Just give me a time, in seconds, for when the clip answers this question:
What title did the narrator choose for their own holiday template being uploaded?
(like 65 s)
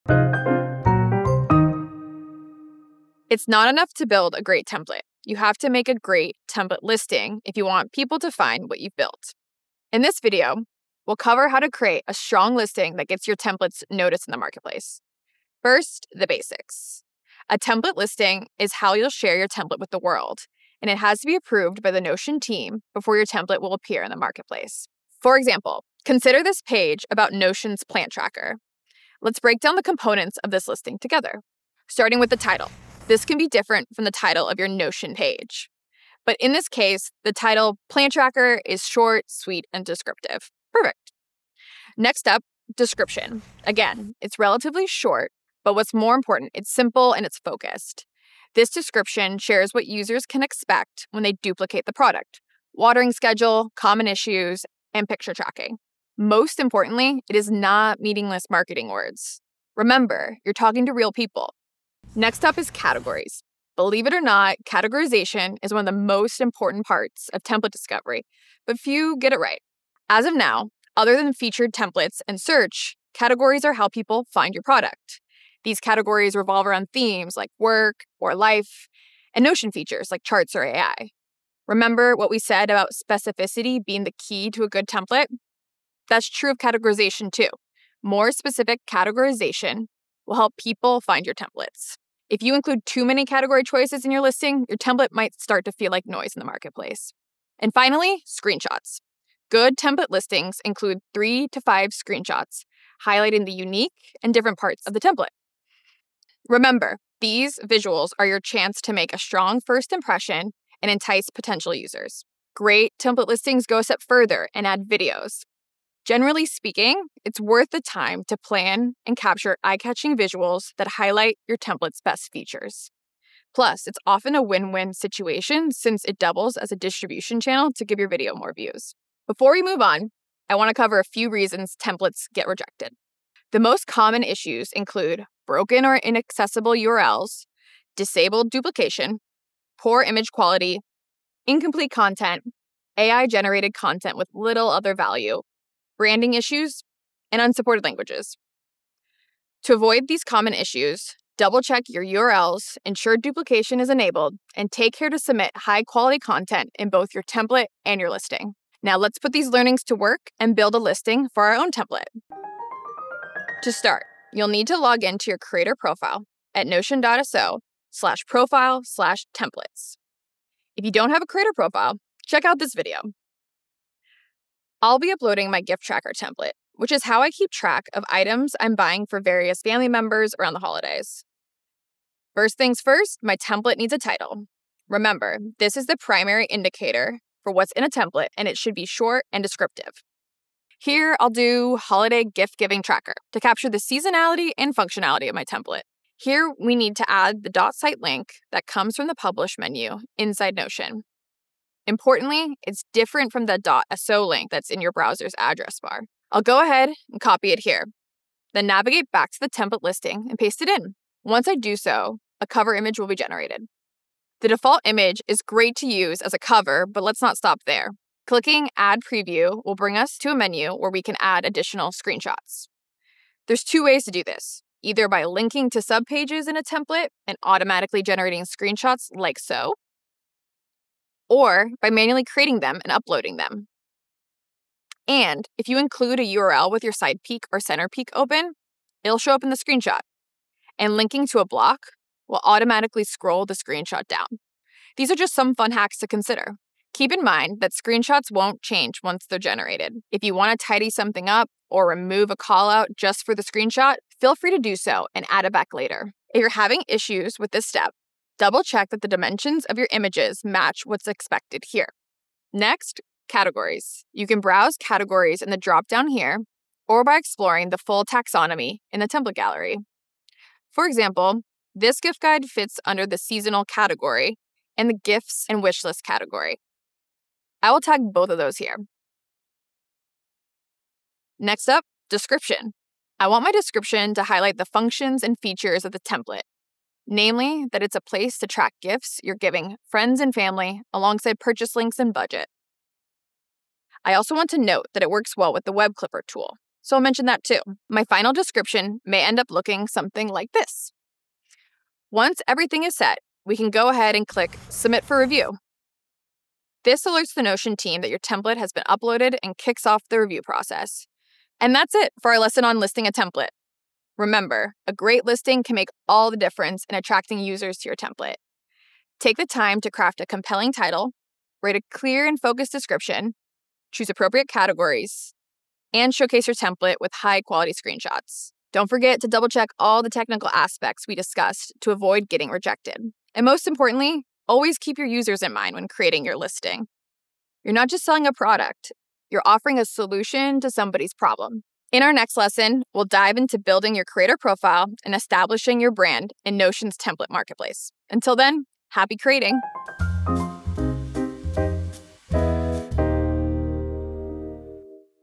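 191 s.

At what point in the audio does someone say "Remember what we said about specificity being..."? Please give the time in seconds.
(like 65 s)
81 s.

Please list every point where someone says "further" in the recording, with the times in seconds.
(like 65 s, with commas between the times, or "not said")
114 s.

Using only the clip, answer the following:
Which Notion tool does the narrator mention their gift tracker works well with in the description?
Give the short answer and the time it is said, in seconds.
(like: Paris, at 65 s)
Web Clipper, at 295 s.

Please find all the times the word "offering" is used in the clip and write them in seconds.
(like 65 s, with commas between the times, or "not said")
339 s.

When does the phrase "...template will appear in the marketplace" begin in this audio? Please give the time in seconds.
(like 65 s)
23 s.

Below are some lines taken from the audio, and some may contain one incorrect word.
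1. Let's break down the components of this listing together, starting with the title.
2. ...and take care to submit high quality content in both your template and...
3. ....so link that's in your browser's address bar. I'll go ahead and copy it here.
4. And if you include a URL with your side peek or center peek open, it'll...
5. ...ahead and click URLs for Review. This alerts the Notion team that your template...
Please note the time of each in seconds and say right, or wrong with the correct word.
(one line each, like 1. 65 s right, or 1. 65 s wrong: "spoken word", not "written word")
1. 29 s right
2. 154 s right
3. 203 s right
4. 235 s right
5. 303 s wrong: "Submit", not "URLs".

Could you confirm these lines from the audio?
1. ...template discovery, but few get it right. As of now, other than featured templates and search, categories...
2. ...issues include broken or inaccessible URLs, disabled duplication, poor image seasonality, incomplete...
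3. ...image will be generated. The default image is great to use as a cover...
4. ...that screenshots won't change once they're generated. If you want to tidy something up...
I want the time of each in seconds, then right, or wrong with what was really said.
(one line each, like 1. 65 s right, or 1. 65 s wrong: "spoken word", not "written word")
1. 67 s right
2. 134 s wrong: "quality", not "seasonality"
3. 212 s right
4. 247 s right.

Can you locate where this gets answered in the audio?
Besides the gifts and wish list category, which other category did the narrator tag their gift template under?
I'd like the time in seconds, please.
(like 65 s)
273 s.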